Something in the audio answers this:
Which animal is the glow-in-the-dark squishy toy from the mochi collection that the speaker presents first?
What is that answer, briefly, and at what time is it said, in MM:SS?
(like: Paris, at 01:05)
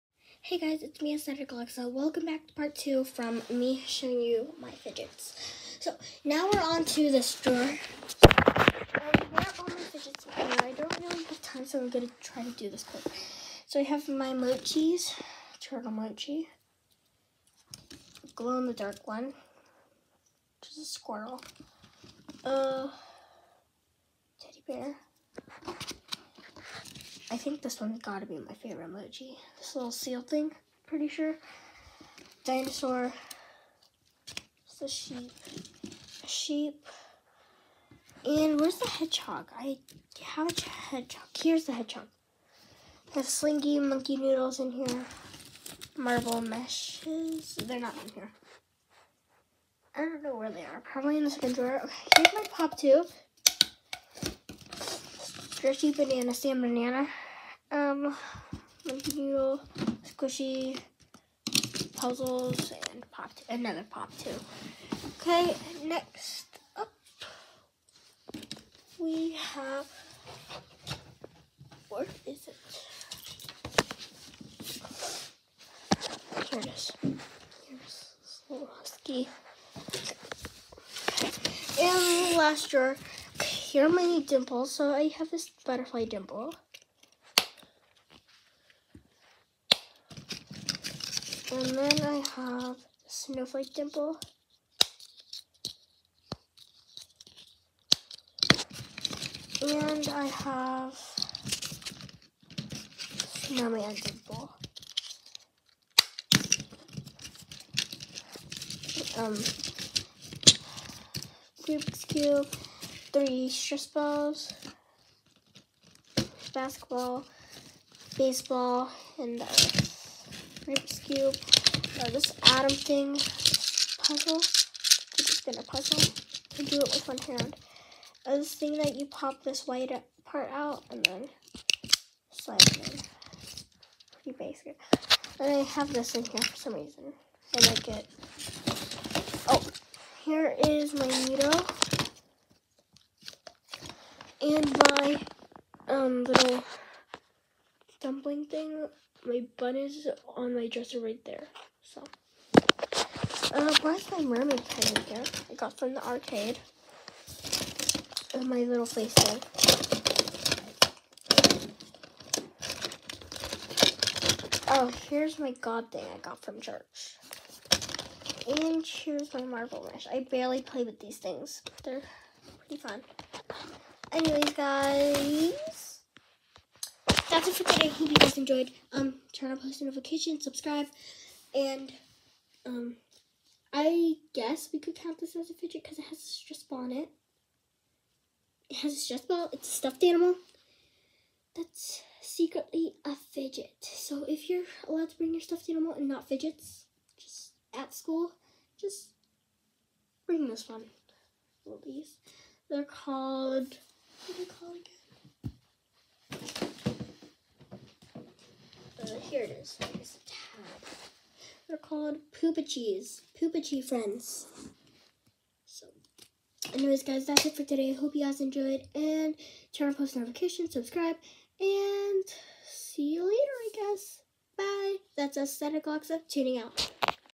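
Squirrel, at 00:20.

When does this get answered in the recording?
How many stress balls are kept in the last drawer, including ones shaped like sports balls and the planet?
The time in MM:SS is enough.
01:53.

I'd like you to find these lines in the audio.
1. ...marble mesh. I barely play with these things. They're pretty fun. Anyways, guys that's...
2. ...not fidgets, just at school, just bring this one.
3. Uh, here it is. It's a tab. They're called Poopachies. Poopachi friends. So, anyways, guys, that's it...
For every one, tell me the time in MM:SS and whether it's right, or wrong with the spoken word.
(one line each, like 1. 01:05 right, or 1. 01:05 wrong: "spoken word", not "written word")
1. 02:49 right
2. 03:16 right
3. 03:29 right.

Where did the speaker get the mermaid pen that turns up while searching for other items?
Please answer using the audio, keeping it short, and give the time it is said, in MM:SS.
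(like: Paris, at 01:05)
The arcade, at 02:35.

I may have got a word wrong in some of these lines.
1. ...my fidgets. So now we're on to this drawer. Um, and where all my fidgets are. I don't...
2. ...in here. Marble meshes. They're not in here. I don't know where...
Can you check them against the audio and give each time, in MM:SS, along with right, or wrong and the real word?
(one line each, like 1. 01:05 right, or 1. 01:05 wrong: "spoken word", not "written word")
1. 00:04 right
2. 00:44 right.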